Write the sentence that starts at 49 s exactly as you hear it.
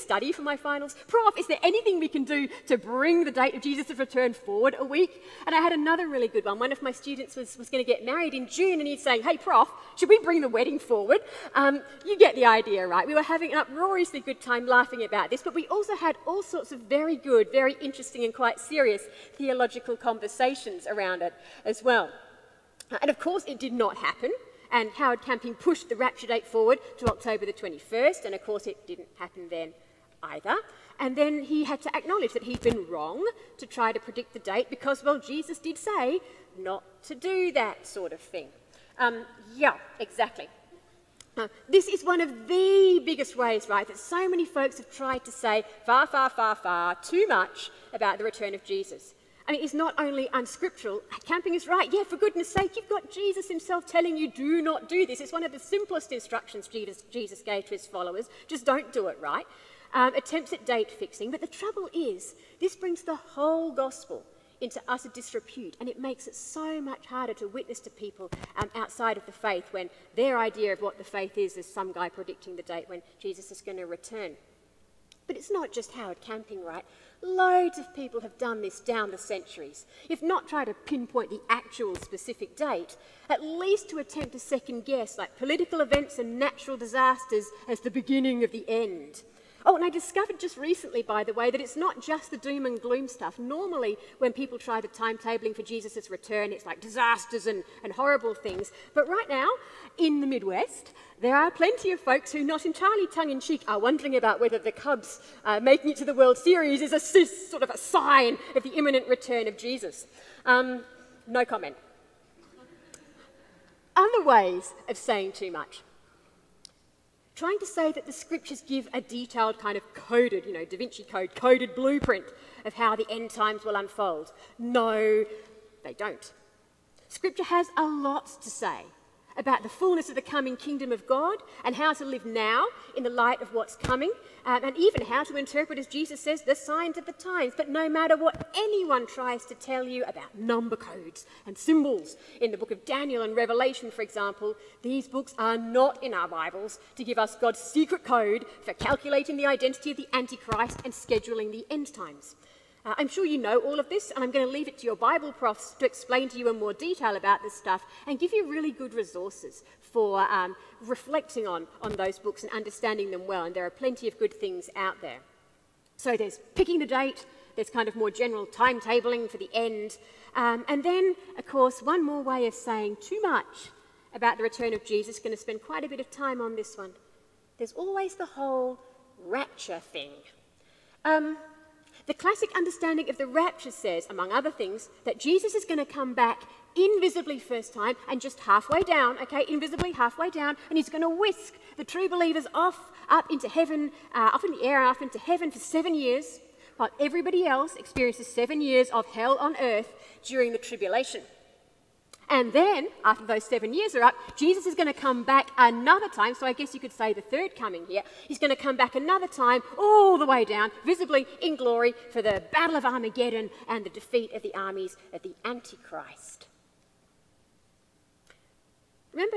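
I mean, it's not only unscriptural, camping is right.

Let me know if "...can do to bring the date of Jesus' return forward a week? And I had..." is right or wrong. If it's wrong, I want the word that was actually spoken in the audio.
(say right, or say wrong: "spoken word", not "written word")
right.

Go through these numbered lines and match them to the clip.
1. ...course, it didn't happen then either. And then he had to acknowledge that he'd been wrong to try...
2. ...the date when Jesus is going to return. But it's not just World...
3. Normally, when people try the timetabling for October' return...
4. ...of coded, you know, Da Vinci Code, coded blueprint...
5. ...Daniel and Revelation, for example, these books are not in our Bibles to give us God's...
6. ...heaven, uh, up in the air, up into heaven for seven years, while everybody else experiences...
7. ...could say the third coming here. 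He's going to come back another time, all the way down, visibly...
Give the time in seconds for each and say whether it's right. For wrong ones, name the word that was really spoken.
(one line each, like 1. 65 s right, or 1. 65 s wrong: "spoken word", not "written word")
1. 28 s right
2. 72 s wrong: "Harold", not "World"
3. 93 s wrong: "Jesus", not "October"
4. 119 s right
5. 142 s right
6. 193 s right
7. 206 s right.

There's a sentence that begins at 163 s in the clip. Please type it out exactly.
And there are plenty of good things out there.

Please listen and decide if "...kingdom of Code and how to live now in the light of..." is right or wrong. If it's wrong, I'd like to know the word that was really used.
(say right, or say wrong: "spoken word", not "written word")
wrong: "God", not "Code".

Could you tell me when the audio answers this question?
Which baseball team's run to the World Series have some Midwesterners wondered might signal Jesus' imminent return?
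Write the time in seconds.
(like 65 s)
104 s.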